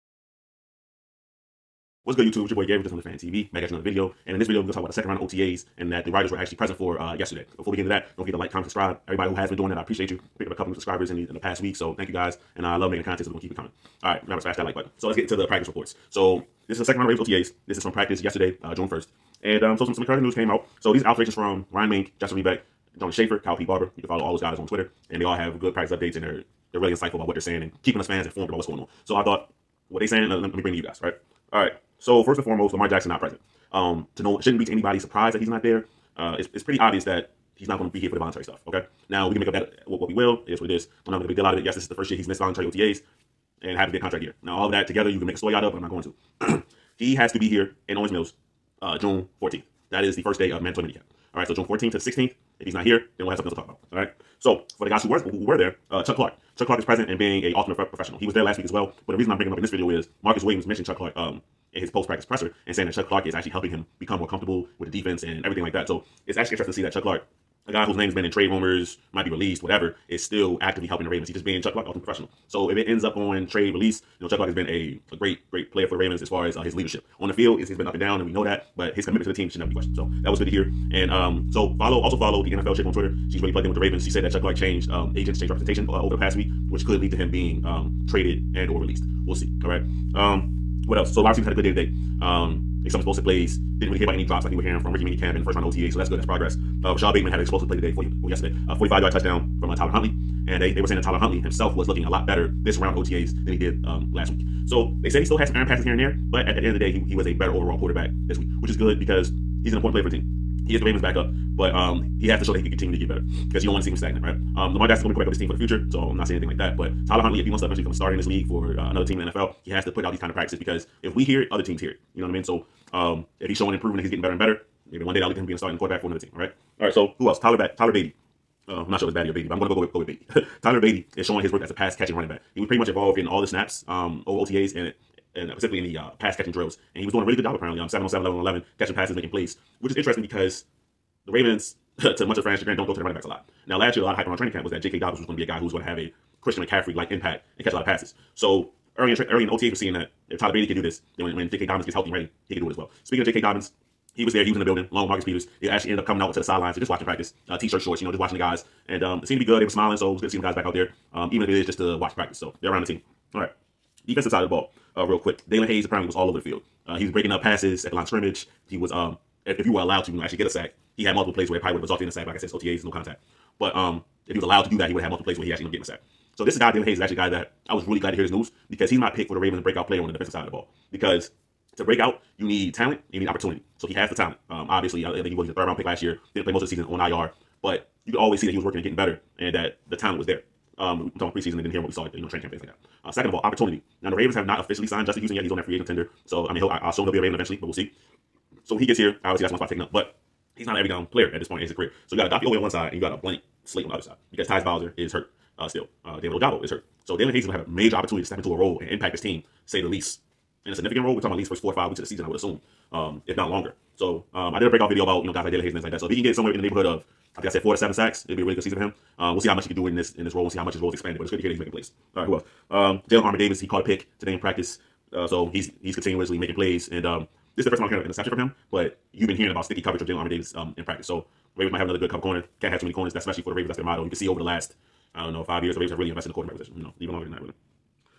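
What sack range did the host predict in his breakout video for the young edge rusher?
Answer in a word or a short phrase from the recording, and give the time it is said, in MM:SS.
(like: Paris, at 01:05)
4 to 7, at 03:37.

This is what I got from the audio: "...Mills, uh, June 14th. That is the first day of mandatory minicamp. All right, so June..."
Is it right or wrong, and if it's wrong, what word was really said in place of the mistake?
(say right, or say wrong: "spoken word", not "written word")
right.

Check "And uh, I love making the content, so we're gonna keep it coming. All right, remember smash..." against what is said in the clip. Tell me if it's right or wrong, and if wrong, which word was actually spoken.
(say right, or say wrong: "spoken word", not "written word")
right.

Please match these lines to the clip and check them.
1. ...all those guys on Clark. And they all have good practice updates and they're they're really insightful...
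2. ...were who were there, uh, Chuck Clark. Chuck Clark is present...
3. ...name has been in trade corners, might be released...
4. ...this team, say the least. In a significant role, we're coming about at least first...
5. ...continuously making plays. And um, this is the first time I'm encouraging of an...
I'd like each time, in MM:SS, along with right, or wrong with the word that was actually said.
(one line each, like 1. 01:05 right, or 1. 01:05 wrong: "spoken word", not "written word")
1. 00:24 wrong: "Twitter", not "Clark"
2. 00:55 right
3. 01:07 wrong: "rumors", not "corners"
4. 03:29 wrong: "talking", not "coming"
5. 03:45 wrong: "hearing", not "encouraging".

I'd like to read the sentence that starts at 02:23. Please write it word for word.
Now, last year, a lot of hype around training camp was that J.K.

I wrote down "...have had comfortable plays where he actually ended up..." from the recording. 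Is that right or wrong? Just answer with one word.
wrong.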